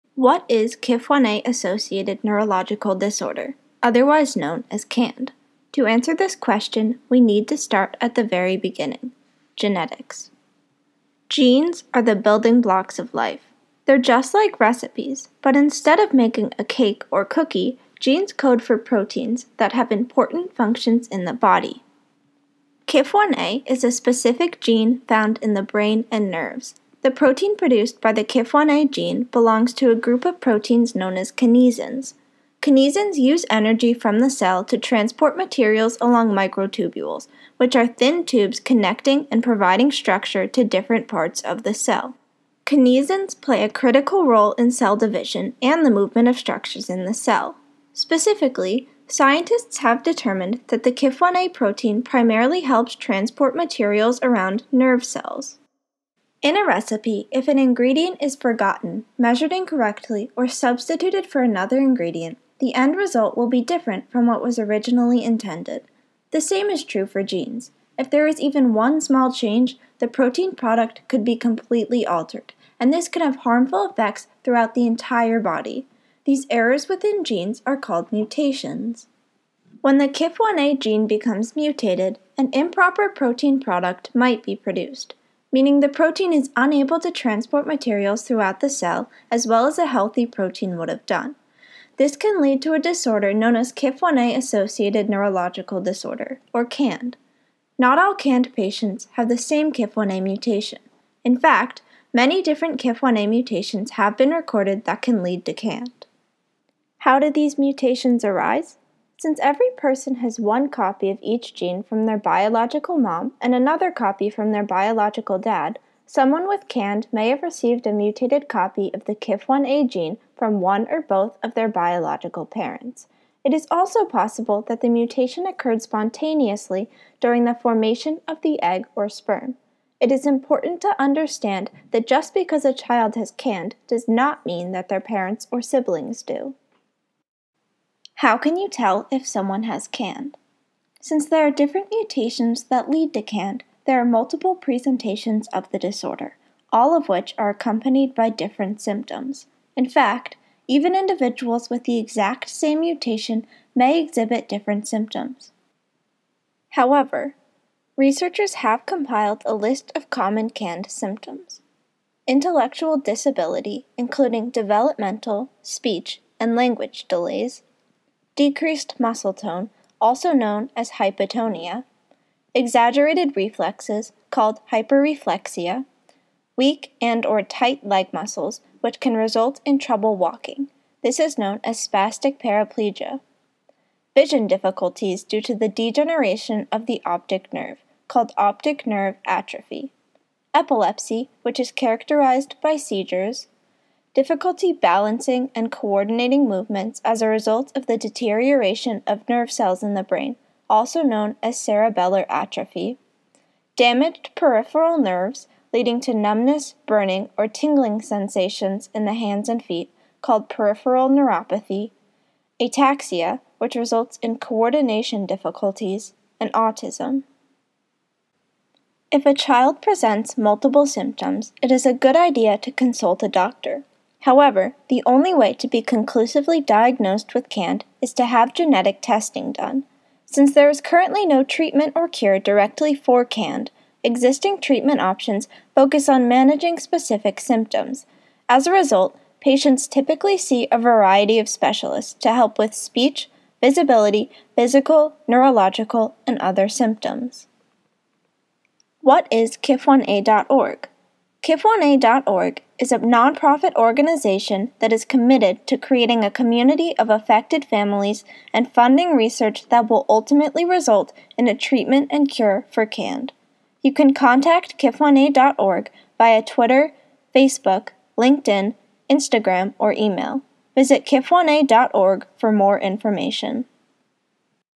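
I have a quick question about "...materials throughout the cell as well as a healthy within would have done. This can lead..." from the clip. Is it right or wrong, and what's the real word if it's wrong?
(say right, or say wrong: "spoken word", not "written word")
wrong: "protein", not "within".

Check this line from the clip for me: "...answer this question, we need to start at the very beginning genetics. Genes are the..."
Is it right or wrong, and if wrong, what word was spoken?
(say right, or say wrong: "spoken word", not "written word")
right.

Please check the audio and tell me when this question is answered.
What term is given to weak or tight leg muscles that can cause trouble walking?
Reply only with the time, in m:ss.
3:01.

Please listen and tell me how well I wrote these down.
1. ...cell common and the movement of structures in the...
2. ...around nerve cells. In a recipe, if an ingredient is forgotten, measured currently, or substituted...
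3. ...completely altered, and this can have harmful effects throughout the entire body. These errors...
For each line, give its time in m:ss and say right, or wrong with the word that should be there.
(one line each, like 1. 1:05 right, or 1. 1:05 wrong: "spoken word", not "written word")
1. 0:44 wrong: "division", not "common"
2. 0:54 wrong: "incorrectly", not "currently"
3. 1:11 right.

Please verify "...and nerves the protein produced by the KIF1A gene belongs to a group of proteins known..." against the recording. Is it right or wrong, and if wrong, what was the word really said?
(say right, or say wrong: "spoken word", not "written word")
right.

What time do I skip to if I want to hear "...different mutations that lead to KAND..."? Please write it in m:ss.
2:21.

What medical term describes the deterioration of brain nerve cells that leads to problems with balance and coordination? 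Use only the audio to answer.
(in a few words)
cerebellar atrophy.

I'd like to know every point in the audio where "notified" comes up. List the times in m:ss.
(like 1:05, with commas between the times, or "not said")
not said.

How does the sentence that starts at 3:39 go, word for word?
If a child presents multiple symptoms, it is a good idea to consult a doctor.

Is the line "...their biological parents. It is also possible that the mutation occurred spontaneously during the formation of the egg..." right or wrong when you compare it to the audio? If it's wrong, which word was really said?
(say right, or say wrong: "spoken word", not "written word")
right.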